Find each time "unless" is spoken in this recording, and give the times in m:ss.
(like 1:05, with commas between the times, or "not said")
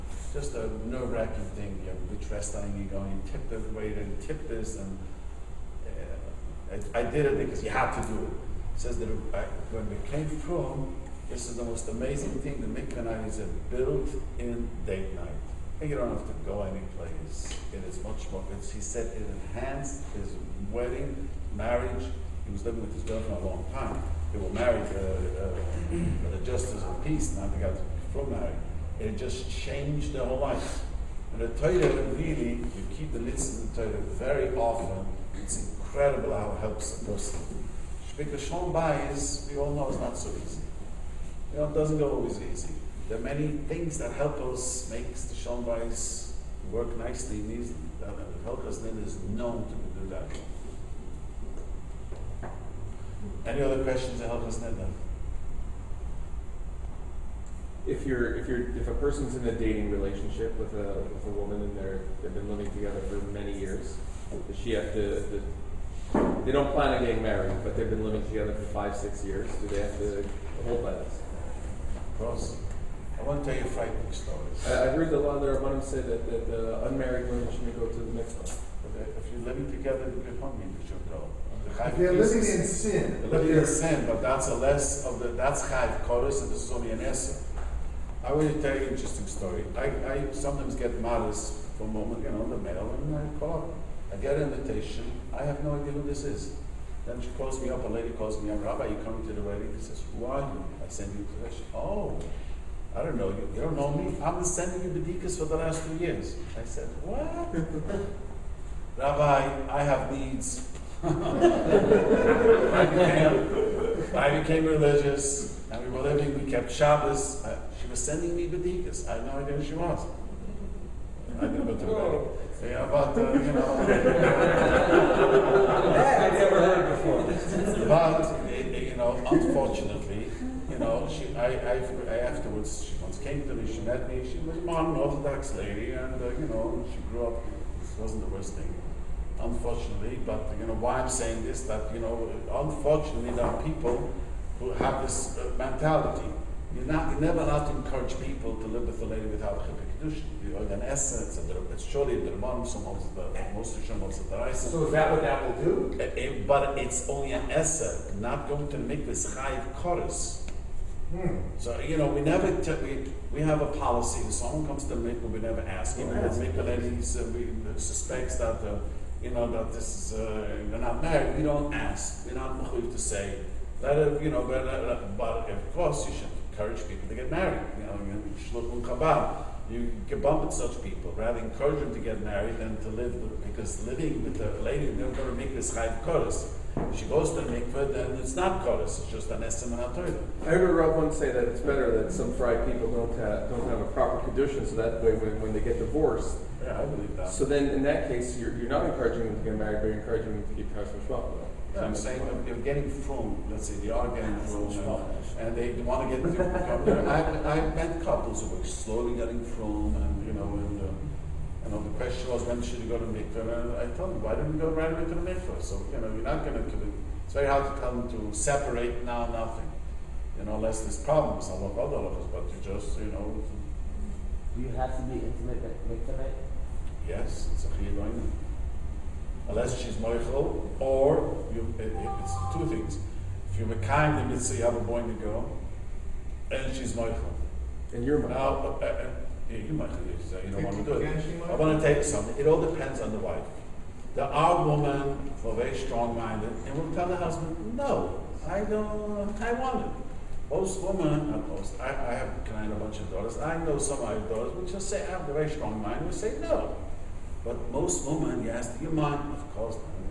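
3:40, 3:49.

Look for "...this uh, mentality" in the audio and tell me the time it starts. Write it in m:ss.
2:25.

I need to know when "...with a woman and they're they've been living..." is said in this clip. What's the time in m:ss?
1:01.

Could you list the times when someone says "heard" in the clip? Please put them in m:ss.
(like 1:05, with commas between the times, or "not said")
1:14, 2:06, 3:10.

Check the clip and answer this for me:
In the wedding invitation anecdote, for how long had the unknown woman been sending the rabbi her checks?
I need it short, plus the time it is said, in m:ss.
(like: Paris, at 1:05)
2 years, at 1:45.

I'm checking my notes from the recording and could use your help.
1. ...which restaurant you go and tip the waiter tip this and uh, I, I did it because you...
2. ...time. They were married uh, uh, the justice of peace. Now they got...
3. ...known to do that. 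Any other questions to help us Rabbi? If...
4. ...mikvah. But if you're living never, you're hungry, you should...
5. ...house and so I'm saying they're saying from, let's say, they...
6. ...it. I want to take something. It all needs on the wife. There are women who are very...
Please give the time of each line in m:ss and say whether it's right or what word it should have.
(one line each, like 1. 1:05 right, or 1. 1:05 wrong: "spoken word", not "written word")
1. 0:02 right
2. 0:23 right
3. 0:49 wrong: "Nidda", not "Rabbi"
4. 1:18 wrong: "together", not "never"
5. 3:20 wrong: "getting", not "saying"
6. 4:00 wrong: "depends", not "needs".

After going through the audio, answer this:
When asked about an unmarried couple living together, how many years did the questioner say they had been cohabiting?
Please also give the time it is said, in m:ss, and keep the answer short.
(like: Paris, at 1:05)
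5 or 6 years, at 1:08.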